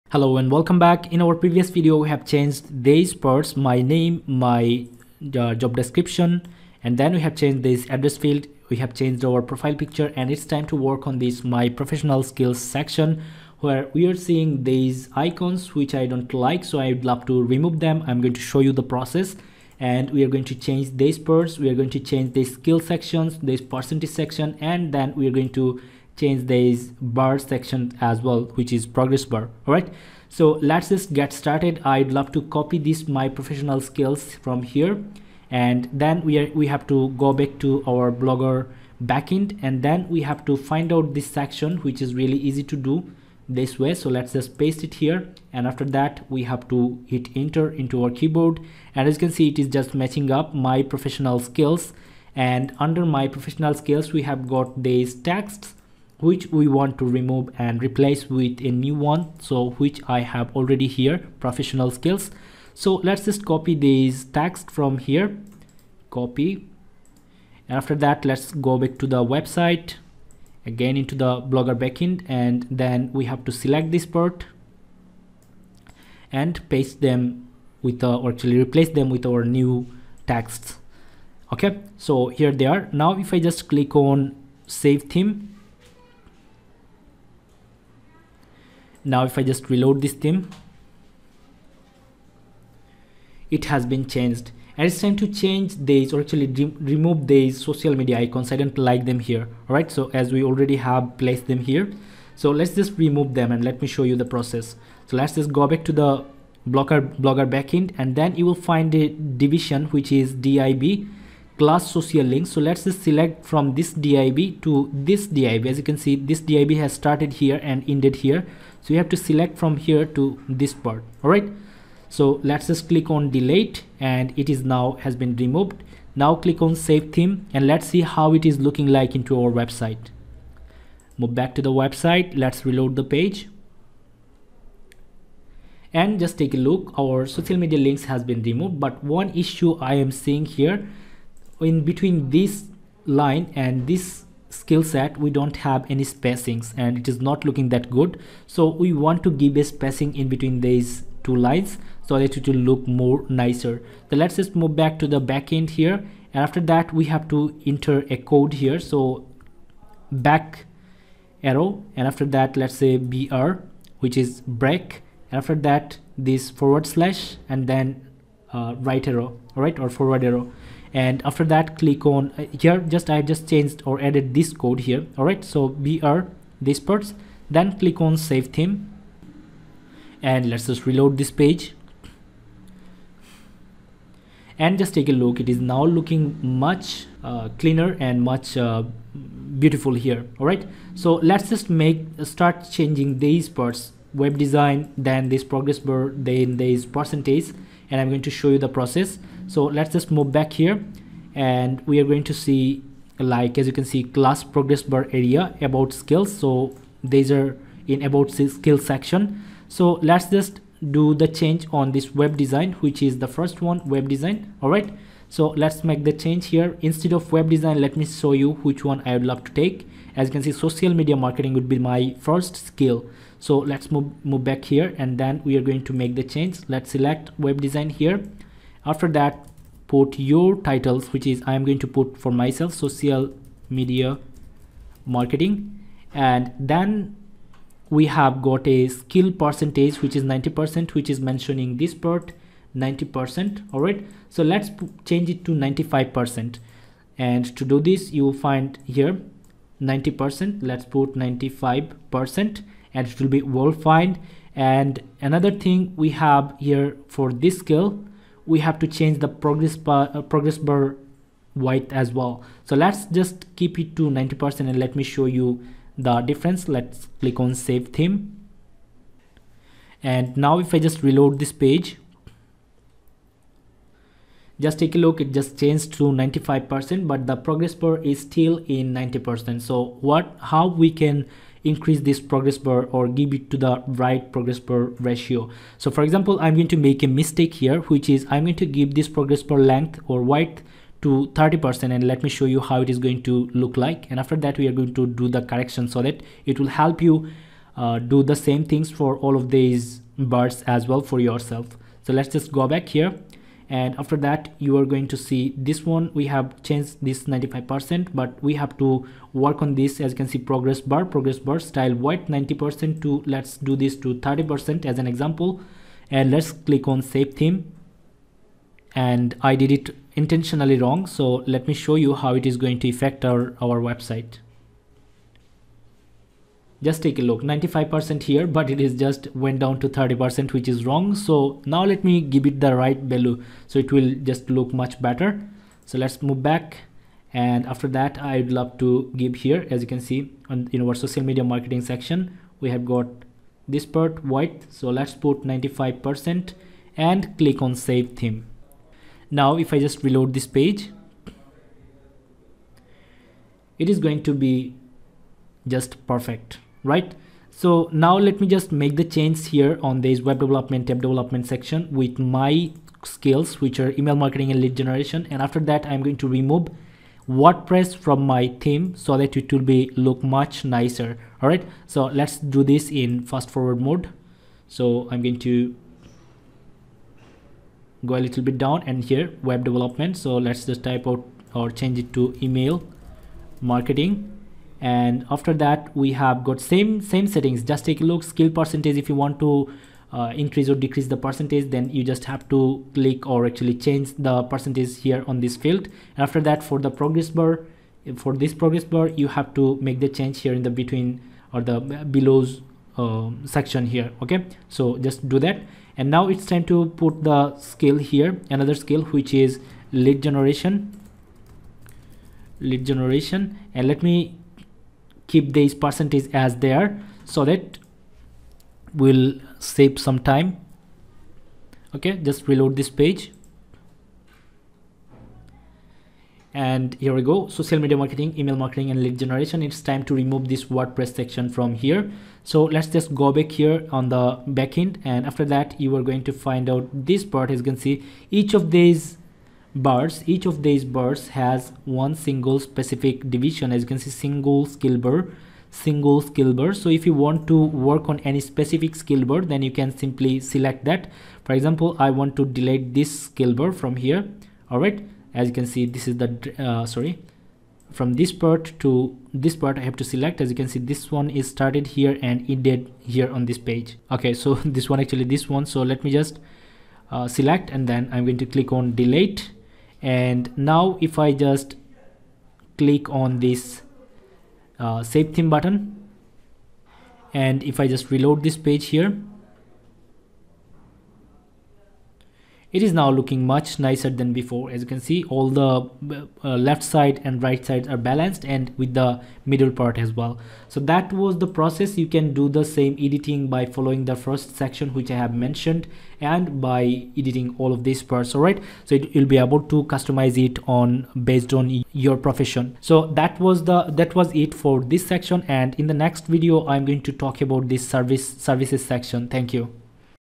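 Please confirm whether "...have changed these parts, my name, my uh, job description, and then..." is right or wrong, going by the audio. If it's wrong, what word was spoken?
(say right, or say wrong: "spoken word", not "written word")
right.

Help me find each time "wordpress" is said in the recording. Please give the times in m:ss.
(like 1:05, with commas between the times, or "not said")
6:07, 7:10.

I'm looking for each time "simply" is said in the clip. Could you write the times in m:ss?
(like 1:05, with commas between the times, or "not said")
7:29.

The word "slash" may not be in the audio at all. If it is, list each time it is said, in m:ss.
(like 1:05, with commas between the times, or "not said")
2:46.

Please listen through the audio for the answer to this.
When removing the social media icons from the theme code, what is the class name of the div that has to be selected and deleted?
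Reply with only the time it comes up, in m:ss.
1:50.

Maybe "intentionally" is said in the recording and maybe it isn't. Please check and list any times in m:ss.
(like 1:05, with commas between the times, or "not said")
5:20.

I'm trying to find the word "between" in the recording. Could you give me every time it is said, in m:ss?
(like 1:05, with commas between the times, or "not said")
2:21, 2:30, 6:40.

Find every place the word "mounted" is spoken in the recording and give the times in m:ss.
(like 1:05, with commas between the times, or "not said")
not said.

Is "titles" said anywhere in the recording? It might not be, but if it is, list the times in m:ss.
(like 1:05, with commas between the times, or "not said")
3:50.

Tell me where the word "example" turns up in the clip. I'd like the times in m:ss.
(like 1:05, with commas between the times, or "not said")
4:46, 5:15, 7:31.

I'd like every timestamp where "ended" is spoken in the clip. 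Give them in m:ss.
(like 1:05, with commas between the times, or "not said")
1:57, 7:42.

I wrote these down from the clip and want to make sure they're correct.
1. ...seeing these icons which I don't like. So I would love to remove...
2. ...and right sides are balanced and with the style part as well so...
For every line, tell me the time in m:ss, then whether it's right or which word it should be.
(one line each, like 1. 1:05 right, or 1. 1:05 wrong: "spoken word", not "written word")
1. 0:14 right
2. 8:07 wrong: "middle", not "style".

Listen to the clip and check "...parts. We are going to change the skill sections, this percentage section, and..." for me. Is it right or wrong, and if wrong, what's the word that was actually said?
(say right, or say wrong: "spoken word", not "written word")
right.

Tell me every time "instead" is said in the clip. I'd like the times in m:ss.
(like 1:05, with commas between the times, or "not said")
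3:36.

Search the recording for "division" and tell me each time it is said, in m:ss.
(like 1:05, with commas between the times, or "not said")
1:49, 7:23.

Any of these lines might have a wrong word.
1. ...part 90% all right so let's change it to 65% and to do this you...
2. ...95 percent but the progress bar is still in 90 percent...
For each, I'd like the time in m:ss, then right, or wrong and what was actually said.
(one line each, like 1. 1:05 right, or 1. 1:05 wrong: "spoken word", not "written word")
1. 4:01 wrong: "95", not "65"
2. 4:36 right.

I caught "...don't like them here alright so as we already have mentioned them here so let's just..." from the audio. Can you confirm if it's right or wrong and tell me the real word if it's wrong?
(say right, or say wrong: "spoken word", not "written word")
wrong: "placed", not "mentioned".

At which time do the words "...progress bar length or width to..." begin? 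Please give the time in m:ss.
4:49.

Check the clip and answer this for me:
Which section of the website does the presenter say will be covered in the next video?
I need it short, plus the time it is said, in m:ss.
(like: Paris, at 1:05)
Services section, at 8:28.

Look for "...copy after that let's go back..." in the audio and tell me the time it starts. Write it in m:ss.
1:06.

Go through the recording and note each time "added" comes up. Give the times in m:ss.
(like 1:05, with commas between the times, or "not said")
2:54.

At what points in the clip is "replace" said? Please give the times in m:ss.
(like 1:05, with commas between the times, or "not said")
0:57, 1:18.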